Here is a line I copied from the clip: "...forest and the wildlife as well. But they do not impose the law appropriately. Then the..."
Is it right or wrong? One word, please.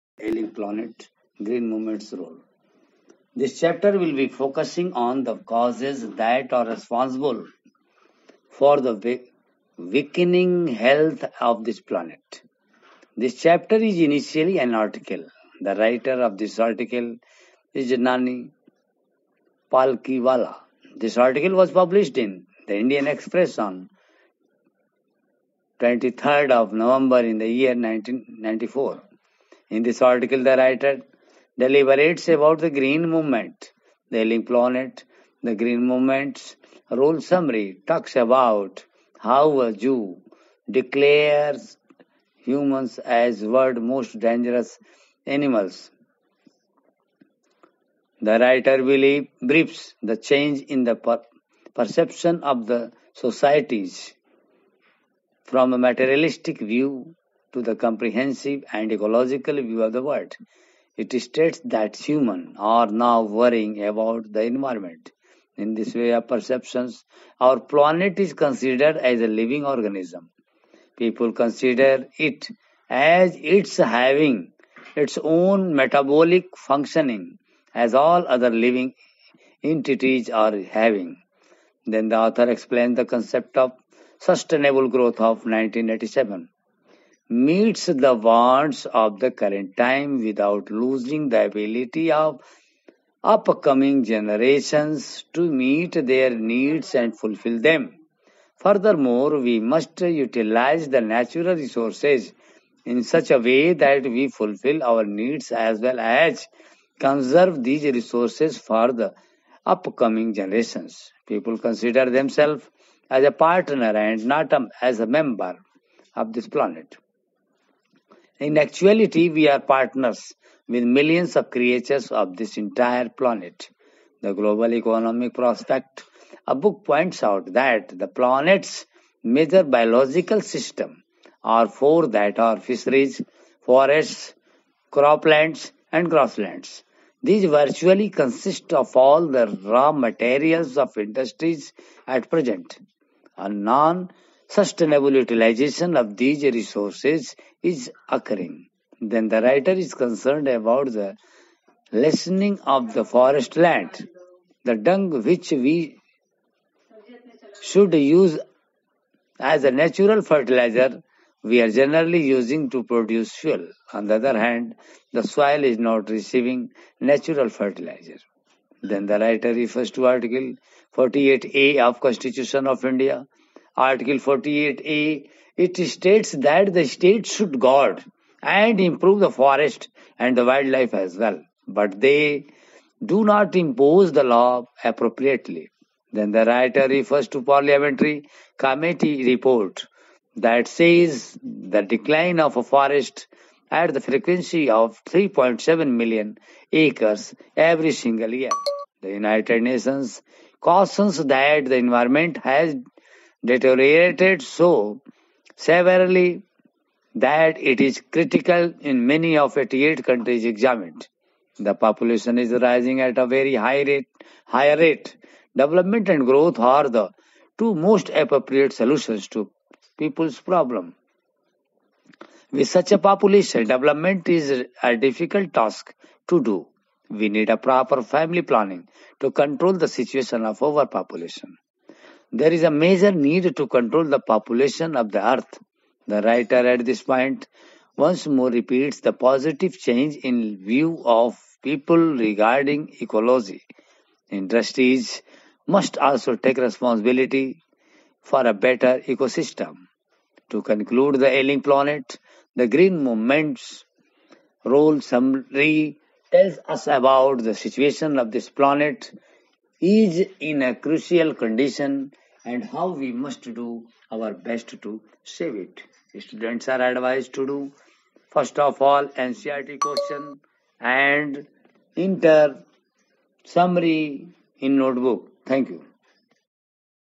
right.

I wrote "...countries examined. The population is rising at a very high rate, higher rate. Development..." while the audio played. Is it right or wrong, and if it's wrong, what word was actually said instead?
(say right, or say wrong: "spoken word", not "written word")
right.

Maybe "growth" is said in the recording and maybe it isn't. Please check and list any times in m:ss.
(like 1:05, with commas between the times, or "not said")
1:24, 3:36.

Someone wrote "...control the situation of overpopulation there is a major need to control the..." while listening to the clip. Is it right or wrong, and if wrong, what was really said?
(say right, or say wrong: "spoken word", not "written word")
right.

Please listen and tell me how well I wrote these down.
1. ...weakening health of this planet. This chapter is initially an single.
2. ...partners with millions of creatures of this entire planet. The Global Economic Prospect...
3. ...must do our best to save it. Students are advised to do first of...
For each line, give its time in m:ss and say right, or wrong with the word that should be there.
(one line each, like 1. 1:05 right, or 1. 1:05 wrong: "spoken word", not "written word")
1. 0:09 wrong: "article", not "single"
2. 1:59 right
3. 4:23 right.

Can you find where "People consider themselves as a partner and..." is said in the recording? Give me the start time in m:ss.
1:51.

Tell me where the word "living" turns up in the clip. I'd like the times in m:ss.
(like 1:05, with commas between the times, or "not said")
1:09, 1:18.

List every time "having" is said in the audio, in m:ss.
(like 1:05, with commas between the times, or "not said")
1:13, 1:20.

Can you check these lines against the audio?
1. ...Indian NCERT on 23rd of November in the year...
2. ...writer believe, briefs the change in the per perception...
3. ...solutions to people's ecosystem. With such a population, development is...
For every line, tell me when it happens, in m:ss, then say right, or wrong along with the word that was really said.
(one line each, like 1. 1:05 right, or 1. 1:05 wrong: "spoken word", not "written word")
1. 0:22 wrong: "Express", not "NCERT"
2. 0:48 right
3. 3:38 wrong: "problem", not "ecosystem".